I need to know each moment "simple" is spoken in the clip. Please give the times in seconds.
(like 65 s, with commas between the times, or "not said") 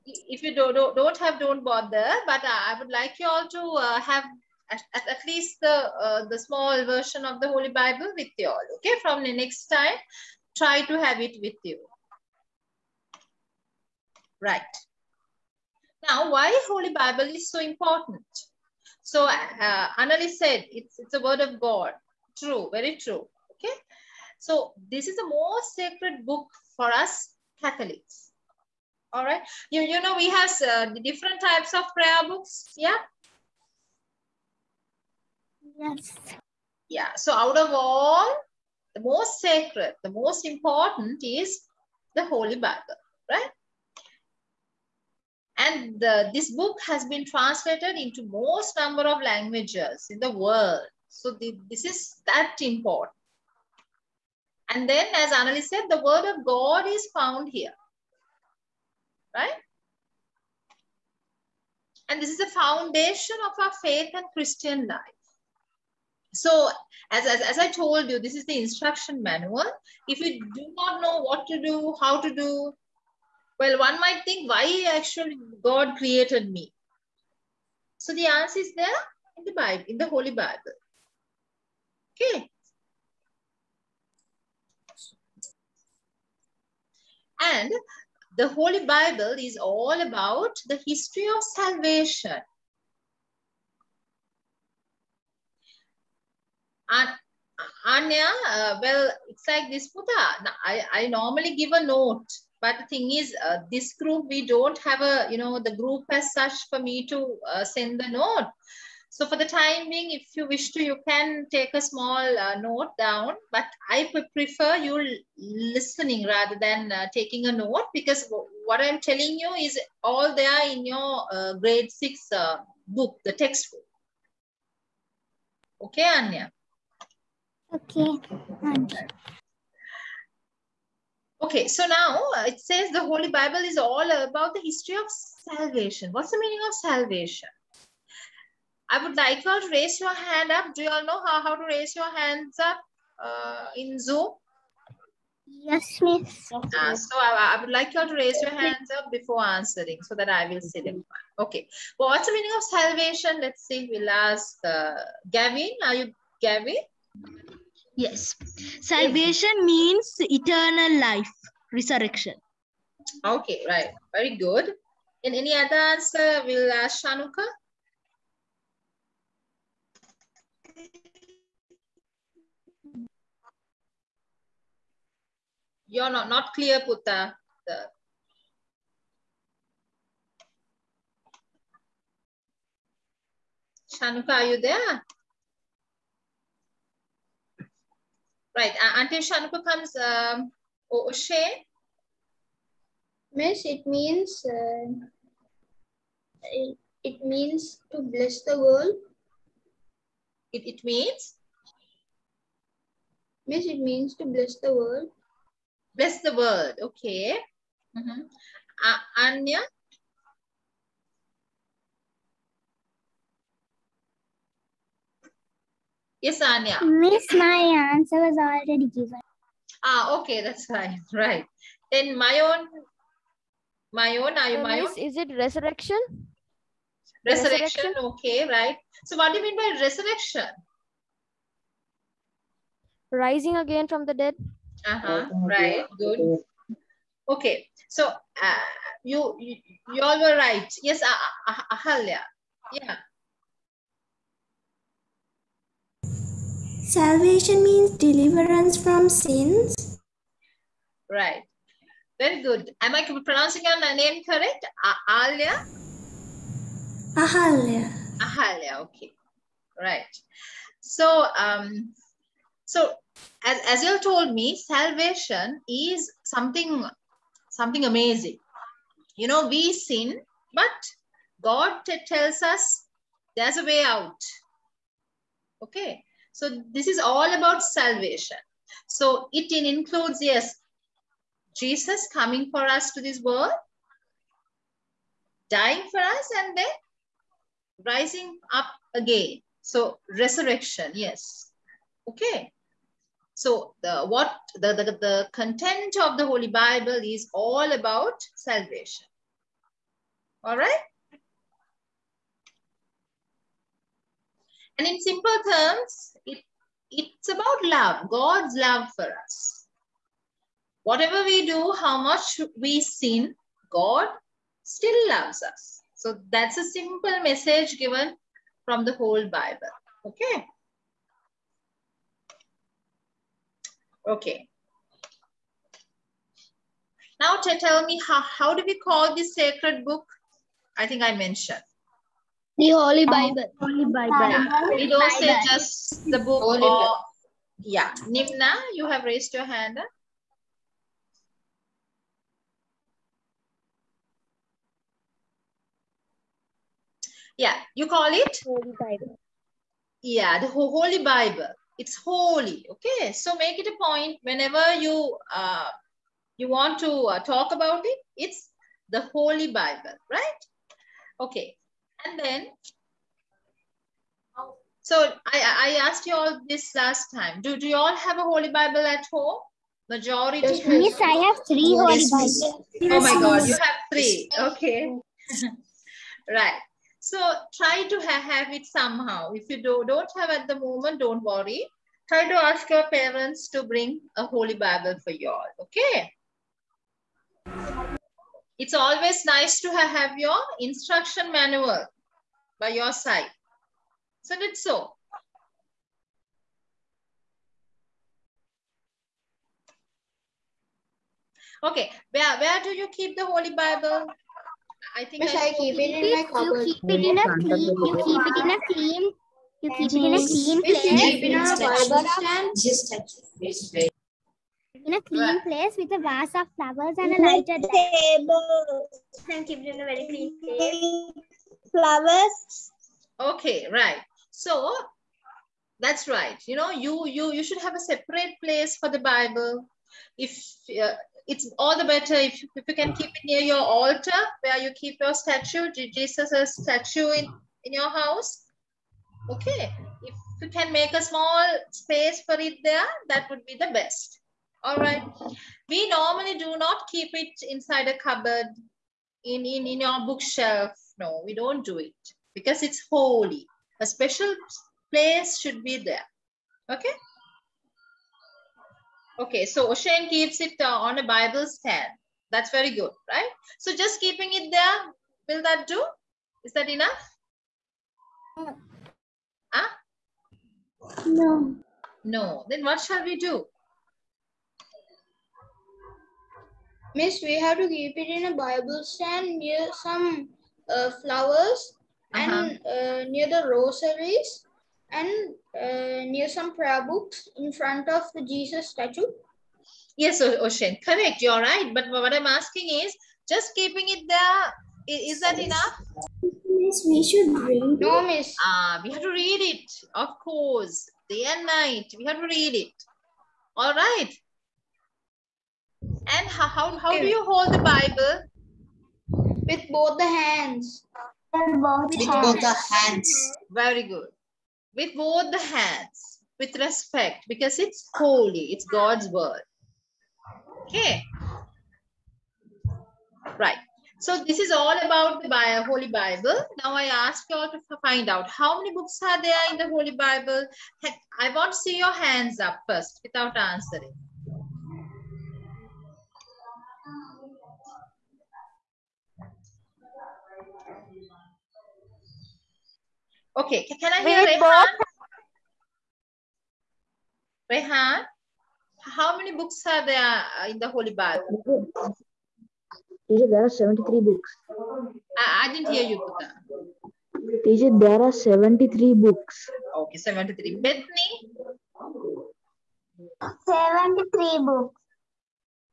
305 s, 316 s.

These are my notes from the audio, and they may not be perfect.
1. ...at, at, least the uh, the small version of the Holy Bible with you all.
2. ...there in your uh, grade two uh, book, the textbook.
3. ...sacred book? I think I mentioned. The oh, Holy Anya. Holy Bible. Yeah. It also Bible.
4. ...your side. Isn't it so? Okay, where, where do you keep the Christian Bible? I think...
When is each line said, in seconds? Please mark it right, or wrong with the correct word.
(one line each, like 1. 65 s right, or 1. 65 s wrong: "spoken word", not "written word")
1. 4 s right
2. 120 s wrong: "six", not "two"
3. 329 s wrong: "Bible", not "Anya"
4. 392 s wrong: "Holy", not "Christian".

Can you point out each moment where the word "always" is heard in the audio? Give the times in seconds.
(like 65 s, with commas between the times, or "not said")
388 s.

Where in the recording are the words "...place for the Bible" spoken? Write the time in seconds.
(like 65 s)
428 s.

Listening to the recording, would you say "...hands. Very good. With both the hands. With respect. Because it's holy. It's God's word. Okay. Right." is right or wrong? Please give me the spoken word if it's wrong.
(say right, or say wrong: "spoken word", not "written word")
right.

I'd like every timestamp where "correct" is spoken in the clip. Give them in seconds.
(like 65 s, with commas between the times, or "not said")
254 s, 490 s.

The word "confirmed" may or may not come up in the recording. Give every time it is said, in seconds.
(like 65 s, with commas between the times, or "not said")
not said.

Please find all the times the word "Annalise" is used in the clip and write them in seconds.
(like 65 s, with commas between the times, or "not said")
19 s, 55 s.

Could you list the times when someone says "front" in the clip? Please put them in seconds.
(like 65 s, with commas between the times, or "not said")
487 s.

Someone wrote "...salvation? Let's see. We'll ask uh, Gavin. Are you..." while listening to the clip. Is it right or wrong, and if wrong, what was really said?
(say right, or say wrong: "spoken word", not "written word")
right.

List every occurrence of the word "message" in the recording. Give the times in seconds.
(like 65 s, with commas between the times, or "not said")
317 s.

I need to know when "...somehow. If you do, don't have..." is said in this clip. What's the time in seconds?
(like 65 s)
378 s.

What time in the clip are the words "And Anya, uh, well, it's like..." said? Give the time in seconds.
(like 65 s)
96 s.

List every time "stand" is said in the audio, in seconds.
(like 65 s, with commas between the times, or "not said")
412 s, 461 s, 478 s.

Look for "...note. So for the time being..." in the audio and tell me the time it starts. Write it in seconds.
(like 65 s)
108 s.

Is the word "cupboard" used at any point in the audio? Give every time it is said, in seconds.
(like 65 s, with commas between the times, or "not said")
406 s, 447 s.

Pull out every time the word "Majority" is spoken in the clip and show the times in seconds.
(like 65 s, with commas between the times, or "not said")
369 s.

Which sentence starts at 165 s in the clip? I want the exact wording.
And any other answer will ask Shanuka?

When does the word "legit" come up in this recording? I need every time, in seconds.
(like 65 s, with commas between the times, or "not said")
not said.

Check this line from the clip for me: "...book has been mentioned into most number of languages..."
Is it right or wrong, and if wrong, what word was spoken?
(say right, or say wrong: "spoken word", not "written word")
wrong: "translated", not "mentioned".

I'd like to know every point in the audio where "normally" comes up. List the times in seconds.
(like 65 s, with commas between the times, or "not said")
101 s, 445 s.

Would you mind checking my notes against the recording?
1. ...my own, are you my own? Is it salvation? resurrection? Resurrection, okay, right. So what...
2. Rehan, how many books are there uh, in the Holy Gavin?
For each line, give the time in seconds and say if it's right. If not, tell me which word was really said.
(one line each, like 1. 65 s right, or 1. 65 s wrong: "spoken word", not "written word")
1. 223 s wrong: "resurrection", not "salvation"
2. 547 s wrong: "Bible", not "Gavin".